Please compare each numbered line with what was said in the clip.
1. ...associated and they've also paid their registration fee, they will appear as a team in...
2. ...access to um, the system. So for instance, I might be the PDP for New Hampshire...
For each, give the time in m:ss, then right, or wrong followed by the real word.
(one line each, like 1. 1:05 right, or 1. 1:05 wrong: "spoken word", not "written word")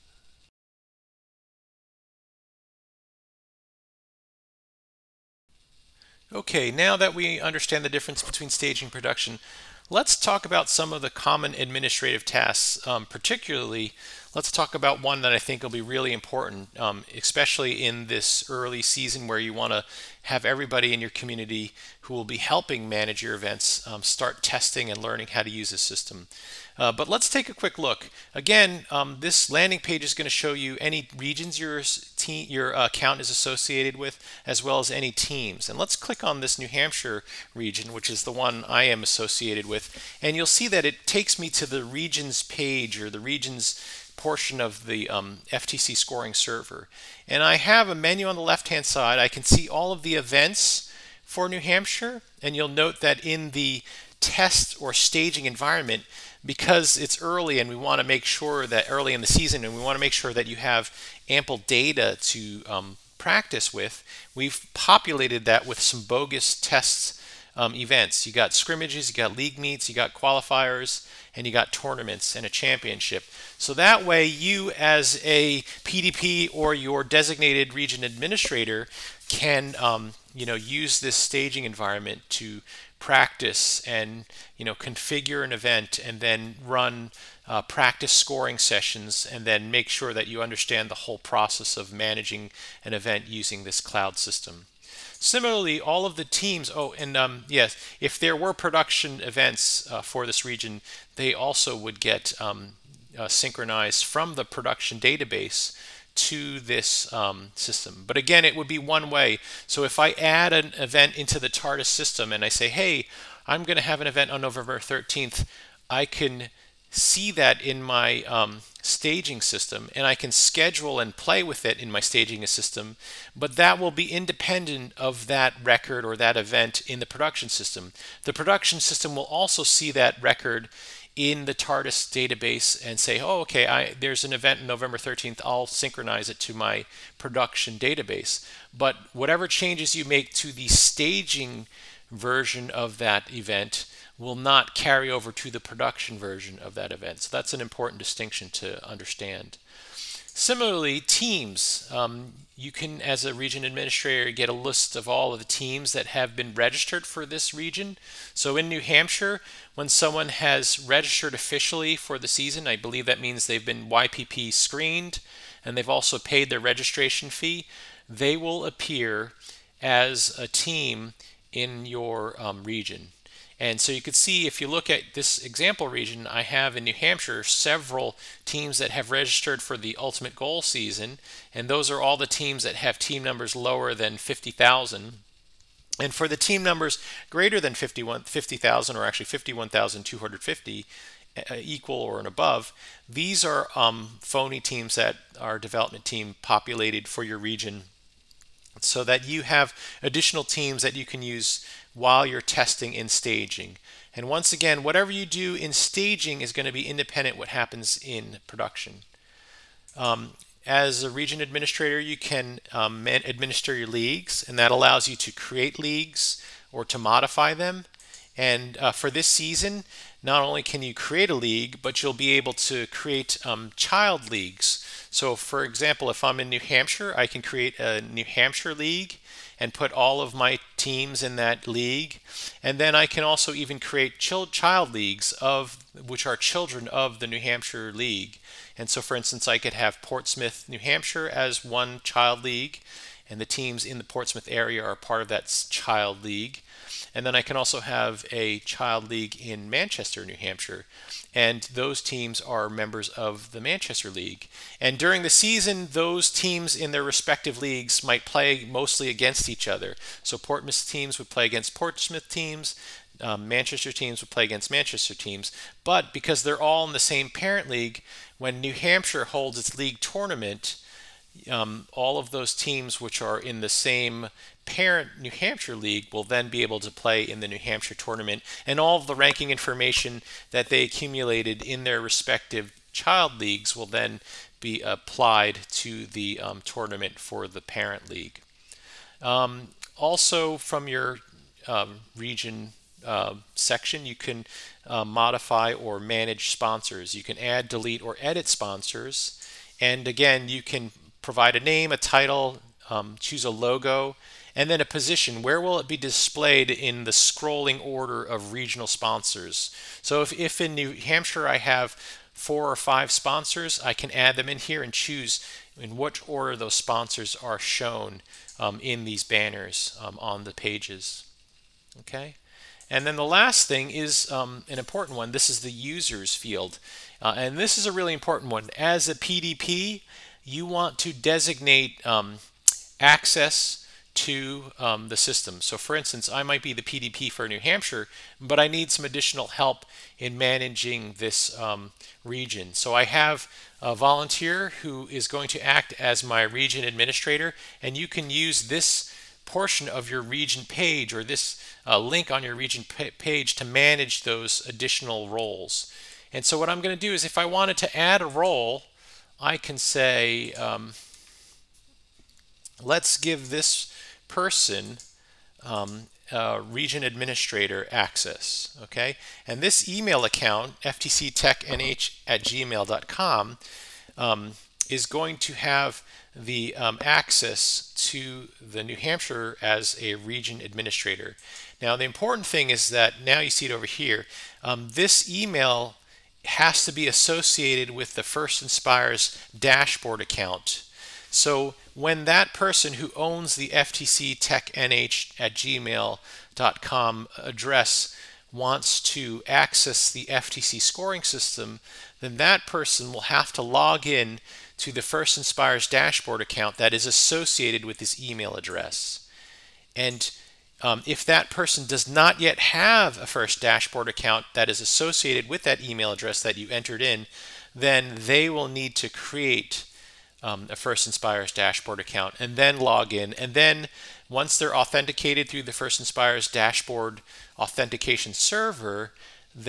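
1. 2:44 wrong: "screened", not "associated"
2. 5:32 right.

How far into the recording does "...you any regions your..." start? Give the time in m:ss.
0:30.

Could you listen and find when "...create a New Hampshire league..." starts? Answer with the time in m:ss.
3:47.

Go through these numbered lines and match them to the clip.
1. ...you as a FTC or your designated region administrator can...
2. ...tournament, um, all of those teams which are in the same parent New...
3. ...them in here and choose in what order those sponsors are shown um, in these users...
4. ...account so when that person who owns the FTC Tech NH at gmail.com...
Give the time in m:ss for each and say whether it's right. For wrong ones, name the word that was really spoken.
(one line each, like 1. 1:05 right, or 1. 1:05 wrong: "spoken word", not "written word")
1. 1:14 wrong: "PDP", not "FTC"
2. 4:29 right
3. 5:14 wrong: "banners", not "users"
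4. 6:30 right.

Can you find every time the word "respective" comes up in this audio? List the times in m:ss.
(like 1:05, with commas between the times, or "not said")
4:17, 4:42.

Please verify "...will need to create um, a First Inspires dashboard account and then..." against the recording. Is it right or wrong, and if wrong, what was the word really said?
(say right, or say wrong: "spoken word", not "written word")
right.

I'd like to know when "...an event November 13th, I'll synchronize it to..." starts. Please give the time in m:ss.
2:14.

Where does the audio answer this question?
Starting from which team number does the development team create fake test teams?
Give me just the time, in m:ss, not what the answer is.
3:09.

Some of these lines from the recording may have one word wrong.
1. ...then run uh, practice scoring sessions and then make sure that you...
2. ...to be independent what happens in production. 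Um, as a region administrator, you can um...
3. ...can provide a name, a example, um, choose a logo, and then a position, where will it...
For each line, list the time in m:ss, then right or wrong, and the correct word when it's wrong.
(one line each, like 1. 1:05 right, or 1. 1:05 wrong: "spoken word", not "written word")
1. 1:26 right
2. 3:26 right
3. 5:00 wrong: "title", not "example".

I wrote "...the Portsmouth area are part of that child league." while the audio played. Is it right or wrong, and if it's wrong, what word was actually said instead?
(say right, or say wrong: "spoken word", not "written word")
right.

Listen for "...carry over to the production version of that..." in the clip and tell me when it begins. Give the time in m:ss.
2:24.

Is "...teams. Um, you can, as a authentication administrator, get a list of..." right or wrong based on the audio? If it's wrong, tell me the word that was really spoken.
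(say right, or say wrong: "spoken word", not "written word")
wrong: "region", not "authentication".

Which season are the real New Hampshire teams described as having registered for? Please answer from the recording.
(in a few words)
Ultimate Goal.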